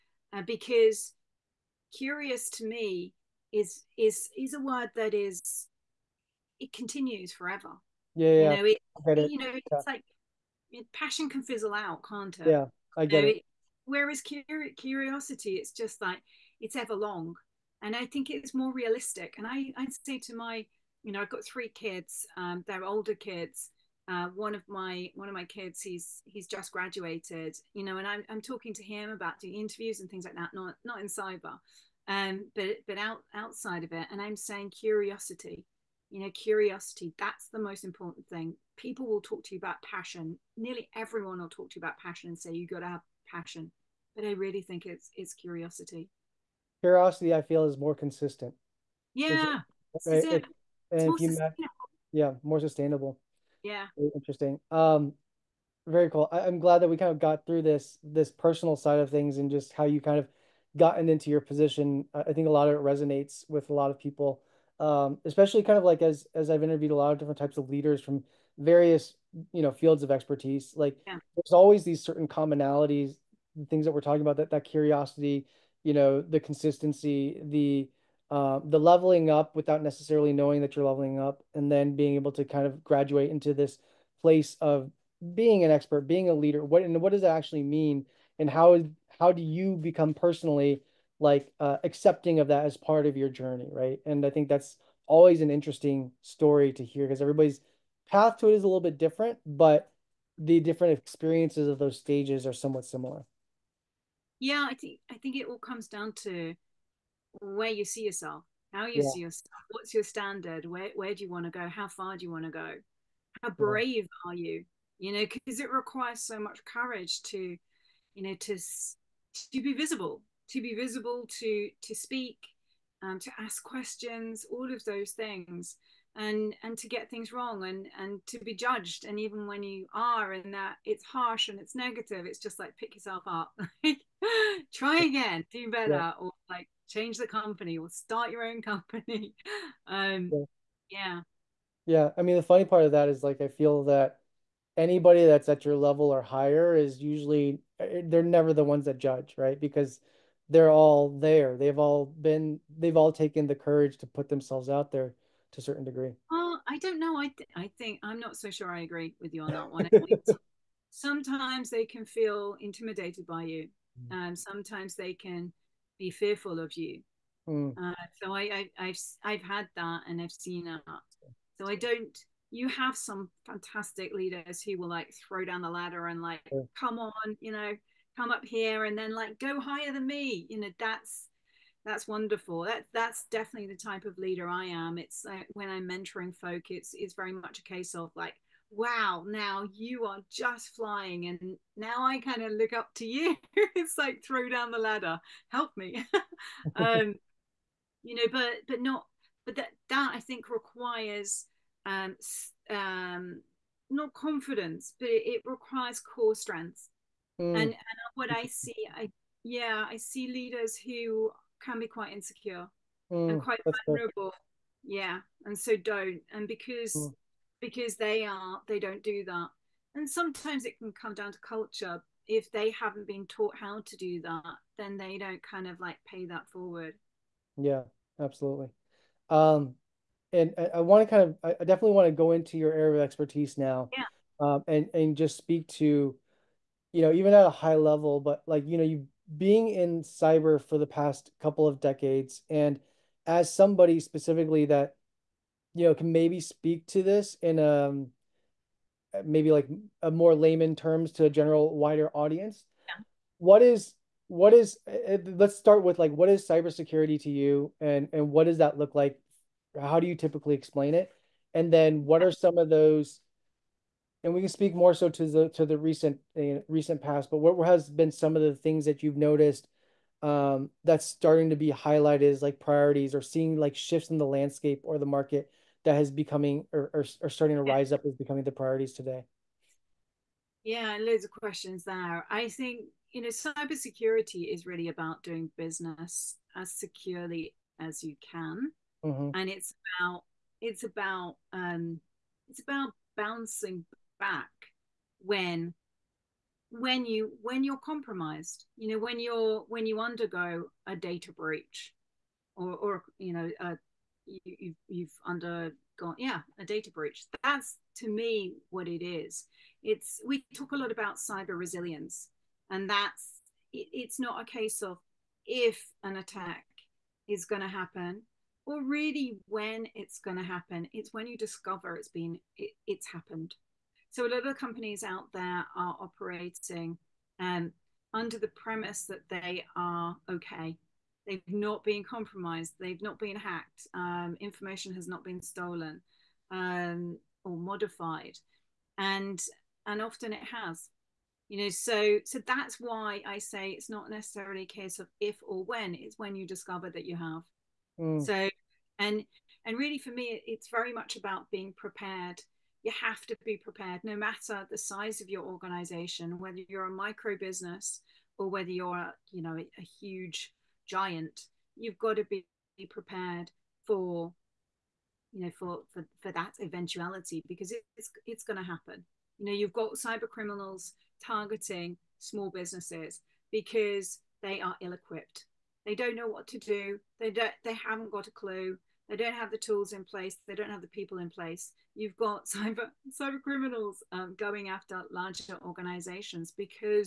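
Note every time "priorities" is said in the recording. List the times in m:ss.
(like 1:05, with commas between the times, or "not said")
4:32, 4:38.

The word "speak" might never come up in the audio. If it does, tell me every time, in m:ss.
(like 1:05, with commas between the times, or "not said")
2:01, 3:55, 4:06, 4:24.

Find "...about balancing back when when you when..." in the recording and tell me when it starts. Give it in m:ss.
4:52.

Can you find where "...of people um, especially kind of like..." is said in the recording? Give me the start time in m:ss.
1:03.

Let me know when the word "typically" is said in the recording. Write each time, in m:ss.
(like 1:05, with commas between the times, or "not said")
4:20.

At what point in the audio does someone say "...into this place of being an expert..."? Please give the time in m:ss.
1:23.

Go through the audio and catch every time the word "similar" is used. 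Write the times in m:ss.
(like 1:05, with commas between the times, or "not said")
1:42.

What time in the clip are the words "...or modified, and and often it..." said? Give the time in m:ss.
5:37.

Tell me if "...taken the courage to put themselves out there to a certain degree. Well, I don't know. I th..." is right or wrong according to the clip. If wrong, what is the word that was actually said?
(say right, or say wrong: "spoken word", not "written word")
right.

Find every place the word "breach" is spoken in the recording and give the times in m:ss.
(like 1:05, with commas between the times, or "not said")
5:01, 5:06.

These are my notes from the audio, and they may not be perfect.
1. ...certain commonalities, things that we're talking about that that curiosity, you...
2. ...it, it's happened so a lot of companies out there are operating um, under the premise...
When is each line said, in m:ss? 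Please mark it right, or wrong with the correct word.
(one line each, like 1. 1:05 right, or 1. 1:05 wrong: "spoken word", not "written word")
1. 1:12 right
2. 5:22 right.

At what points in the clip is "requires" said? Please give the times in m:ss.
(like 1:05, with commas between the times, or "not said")
1:55, 3:20, 3:25.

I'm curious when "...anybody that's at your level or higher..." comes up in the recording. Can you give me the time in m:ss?
2:24.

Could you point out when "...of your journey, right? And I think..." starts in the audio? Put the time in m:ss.
1:33.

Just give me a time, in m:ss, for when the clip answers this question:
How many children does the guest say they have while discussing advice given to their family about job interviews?
0:21.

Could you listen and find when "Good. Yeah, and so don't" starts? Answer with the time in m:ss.
3:34.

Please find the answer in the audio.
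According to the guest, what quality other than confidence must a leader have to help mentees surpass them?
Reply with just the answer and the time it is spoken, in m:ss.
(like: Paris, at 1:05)
Core strength, at 3:25.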